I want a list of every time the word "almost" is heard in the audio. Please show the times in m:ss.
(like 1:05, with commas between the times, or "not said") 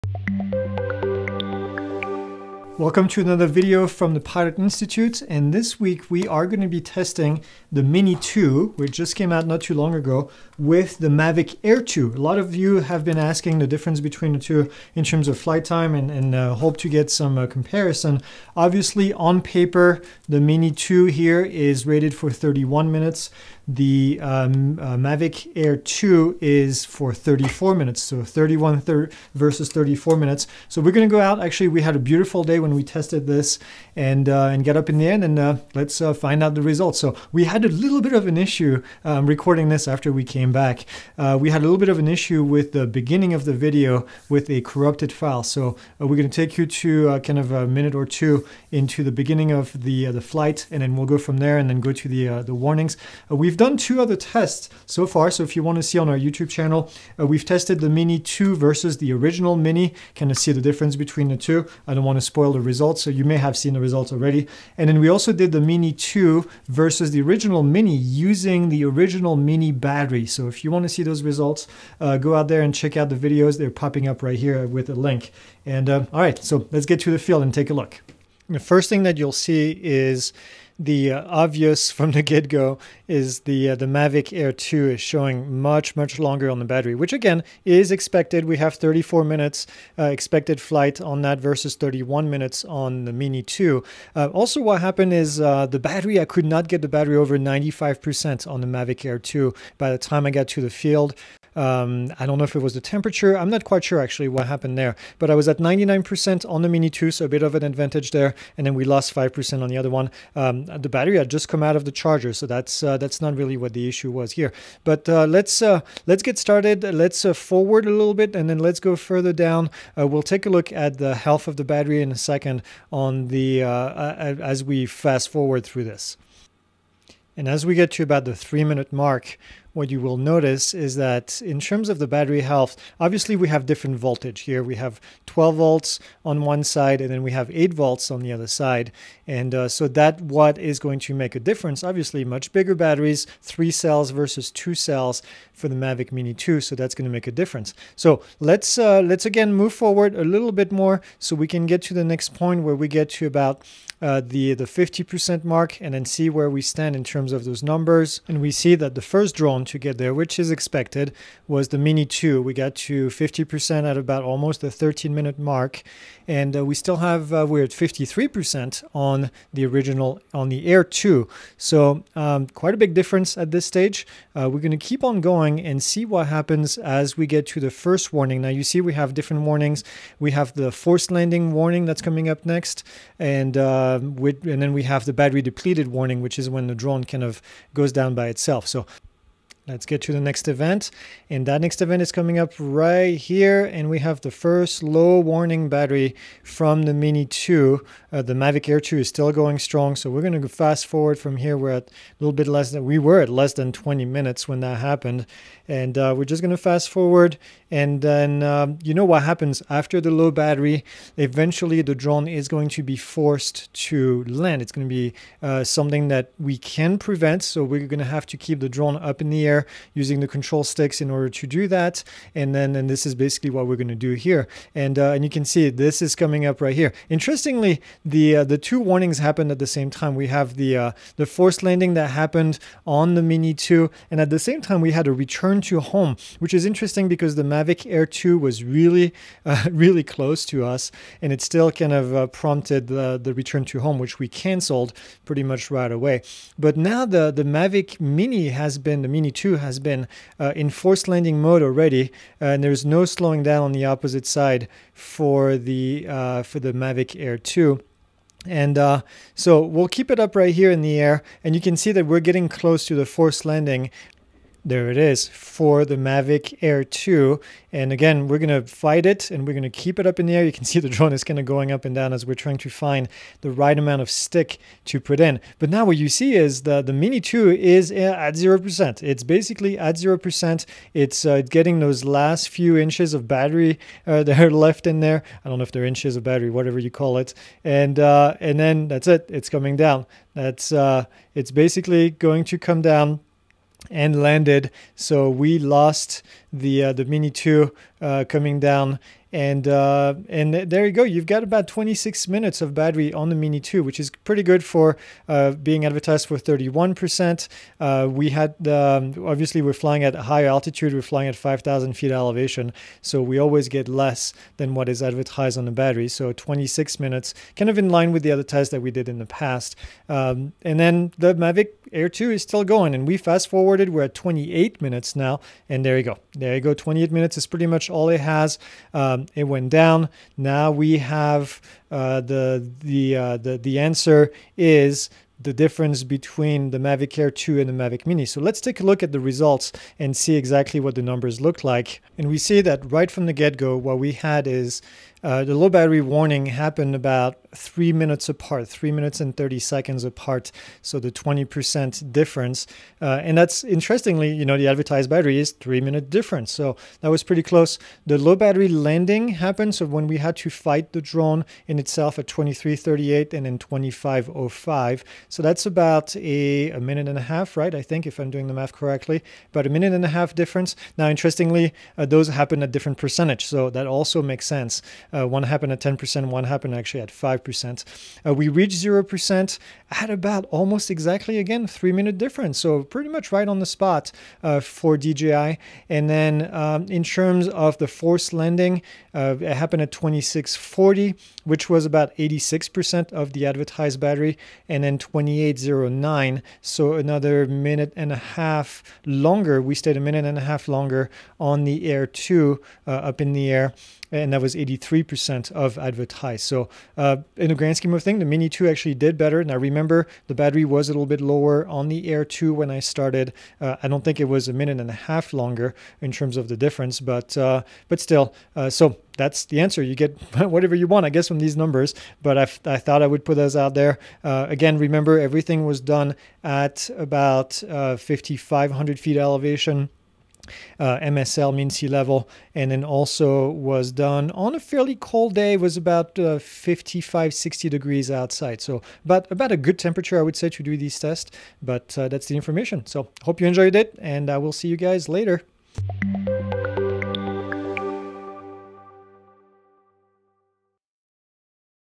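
2:44, 6:20.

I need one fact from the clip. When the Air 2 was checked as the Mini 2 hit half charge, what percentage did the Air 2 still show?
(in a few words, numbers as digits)
53%.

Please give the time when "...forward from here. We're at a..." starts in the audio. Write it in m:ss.
3:20.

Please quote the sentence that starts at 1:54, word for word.
But uh, let's uh, let's get started.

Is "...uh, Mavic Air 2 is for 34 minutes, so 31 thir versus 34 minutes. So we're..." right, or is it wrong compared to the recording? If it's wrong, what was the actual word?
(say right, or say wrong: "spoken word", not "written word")
right.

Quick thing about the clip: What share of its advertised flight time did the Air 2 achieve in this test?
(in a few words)
83%.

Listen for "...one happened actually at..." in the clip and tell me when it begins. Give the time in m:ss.
6:16.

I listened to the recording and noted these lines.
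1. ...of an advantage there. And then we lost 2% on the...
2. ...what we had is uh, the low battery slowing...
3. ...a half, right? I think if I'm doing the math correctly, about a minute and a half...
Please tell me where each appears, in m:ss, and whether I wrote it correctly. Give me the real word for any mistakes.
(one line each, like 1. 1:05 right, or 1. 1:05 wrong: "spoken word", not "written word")
1. 1:47 wrong: "5", not "2"
2. 5:43 wrong: "warning", not "slowing"
3. 6:07 right.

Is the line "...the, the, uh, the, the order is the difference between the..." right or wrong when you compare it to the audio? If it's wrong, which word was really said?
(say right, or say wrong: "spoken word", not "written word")
wrong: "answer", not "order".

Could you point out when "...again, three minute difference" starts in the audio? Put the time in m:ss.
6:21.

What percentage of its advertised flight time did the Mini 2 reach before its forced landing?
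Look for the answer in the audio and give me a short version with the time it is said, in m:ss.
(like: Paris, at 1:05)
86%, at 6:32.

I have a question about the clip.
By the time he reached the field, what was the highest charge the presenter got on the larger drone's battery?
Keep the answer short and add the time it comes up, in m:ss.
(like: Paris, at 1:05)
95%, at 1:37.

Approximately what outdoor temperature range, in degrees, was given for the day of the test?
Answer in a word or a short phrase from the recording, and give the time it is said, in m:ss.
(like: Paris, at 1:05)
55 to 60 degrees, at 7:16.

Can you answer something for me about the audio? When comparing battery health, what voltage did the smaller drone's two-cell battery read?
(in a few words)
8 volts.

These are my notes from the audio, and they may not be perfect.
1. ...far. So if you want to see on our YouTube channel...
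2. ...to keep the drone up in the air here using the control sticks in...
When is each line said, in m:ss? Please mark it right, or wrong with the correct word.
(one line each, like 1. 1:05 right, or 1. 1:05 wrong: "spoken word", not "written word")
1. 0:55 right
2. 3:38 right.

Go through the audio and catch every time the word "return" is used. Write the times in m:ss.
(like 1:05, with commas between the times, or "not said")
3:55, 4:03.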